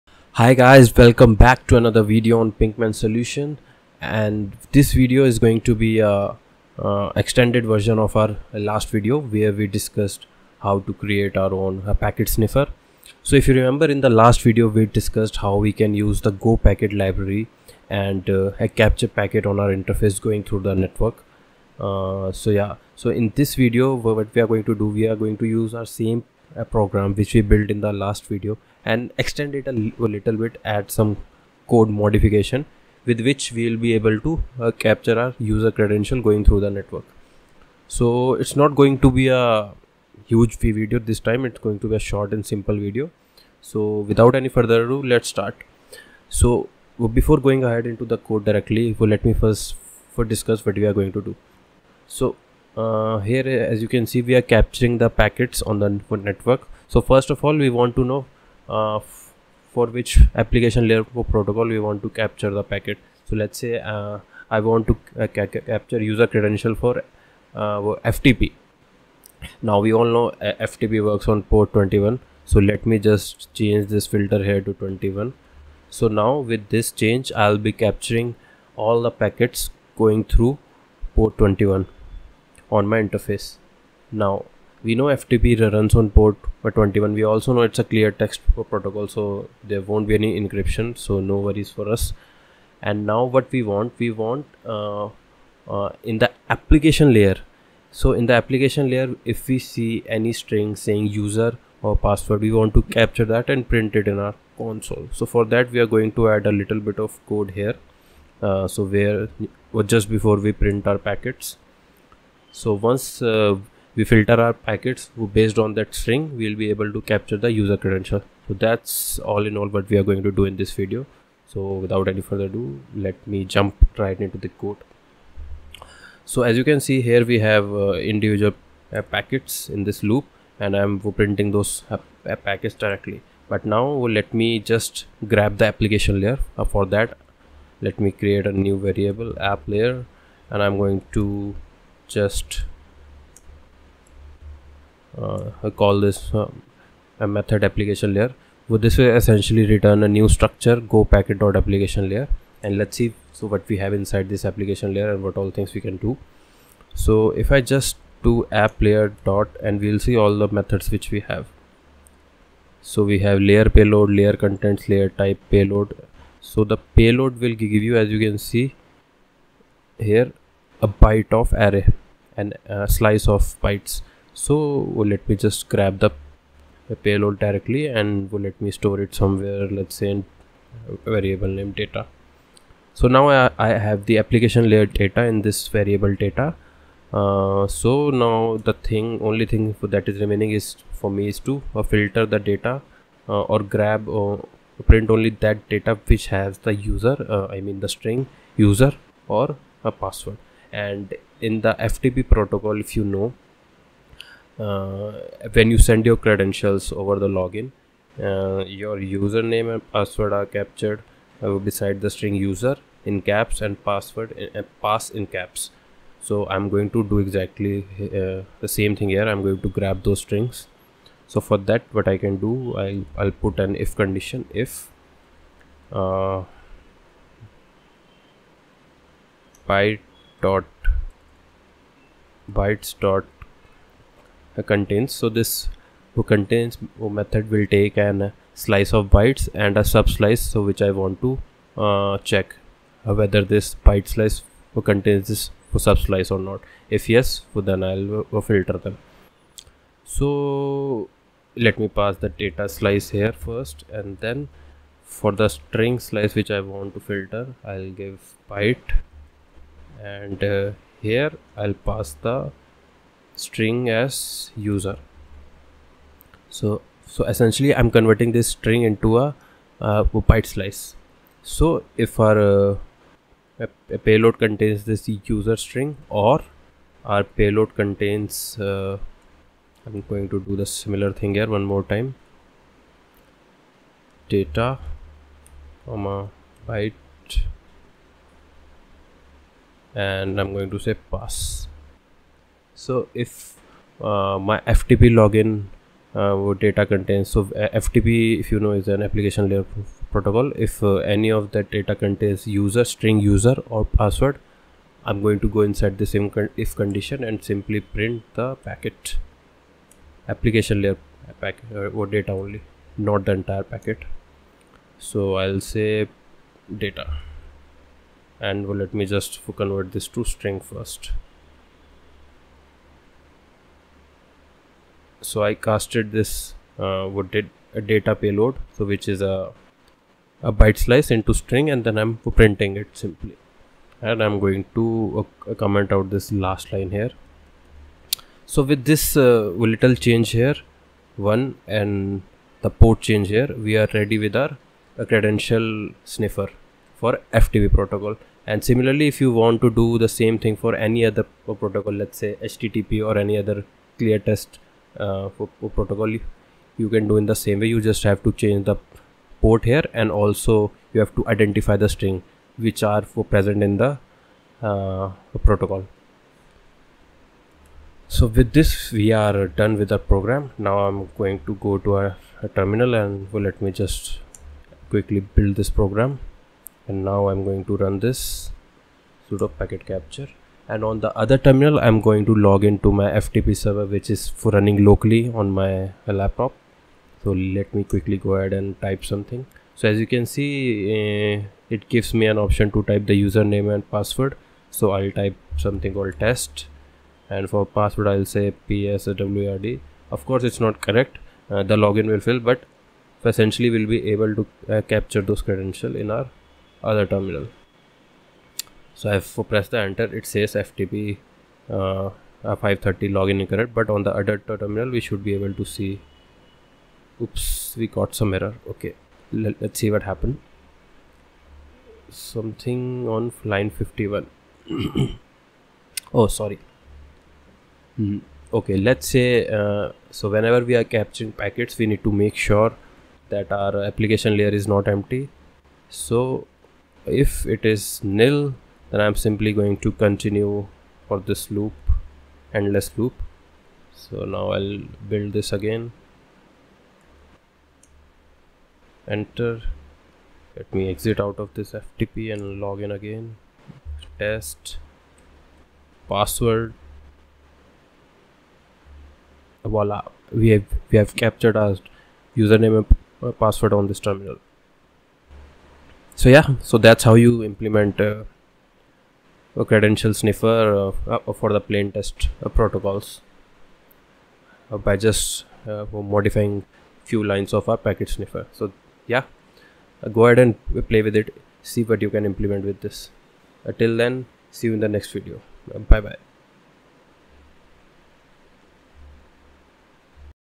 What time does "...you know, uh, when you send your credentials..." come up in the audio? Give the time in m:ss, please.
3:22.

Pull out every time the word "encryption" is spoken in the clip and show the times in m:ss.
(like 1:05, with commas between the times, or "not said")
1:30.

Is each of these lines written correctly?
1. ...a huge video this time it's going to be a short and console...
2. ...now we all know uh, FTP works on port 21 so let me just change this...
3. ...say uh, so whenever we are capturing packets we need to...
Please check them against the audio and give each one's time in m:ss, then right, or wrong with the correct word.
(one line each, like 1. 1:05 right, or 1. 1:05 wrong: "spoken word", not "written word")
1. 0:39 wrong: "simple", not "console"
2. 1:09 right
3. 7:09 right.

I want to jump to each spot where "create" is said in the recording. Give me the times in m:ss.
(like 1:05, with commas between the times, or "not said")
0:10, 2:18.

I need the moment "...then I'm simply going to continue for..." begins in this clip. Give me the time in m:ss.
7:18.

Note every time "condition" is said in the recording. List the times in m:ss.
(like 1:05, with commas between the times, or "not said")
3:43, 5:06.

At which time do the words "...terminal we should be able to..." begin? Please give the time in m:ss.
6:54.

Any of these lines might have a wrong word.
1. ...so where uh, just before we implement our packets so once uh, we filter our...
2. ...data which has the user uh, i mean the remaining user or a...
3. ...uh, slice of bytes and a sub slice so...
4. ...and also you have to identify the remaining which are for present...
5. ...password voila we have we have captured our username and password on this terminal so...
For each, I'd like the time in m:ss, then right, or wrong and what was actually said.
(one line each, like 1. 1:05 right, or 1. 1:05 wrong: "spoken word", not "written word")
1. 1:48 wrong: "print", not "implement"
2. 3:15 wrong: "string", not "remaining"
3. 3:58 right
4. 5:59 wrong: "string", not "remaining"
5. 7:36 right.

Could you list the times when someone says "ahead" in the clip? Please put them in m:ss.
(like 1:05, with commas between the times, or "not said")
0:47, 6:28, 8:00.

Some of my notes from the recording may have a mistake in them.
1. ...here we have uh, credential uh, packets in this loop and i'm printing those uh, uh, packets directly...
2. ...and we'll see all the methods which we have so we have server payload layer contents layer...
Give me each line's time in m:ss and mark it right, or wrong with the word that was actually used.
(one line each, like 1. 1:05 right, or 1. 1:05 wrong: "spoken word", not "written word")
1. 2:07 wrong: "individual", not "credential"
2. 2:39 wrong: "layer", not "server".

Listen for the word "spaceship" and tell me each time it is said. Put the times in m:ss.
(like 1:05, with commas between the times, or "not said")
not said.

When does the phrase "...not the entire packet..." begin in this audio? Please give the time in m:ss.
5:12.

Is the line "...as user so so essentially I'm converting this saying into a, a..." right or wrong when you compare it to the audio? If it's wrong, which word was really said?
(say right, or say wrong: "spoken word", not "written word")
wrong: "string", not "saying".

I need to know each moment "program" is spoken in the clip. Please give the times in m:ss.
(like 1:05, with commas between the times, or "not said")
0:26, 6:09, 6:15.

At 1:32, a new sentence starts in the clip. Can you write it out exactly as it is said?
And now what we want, we want uh, uh, in the application layer.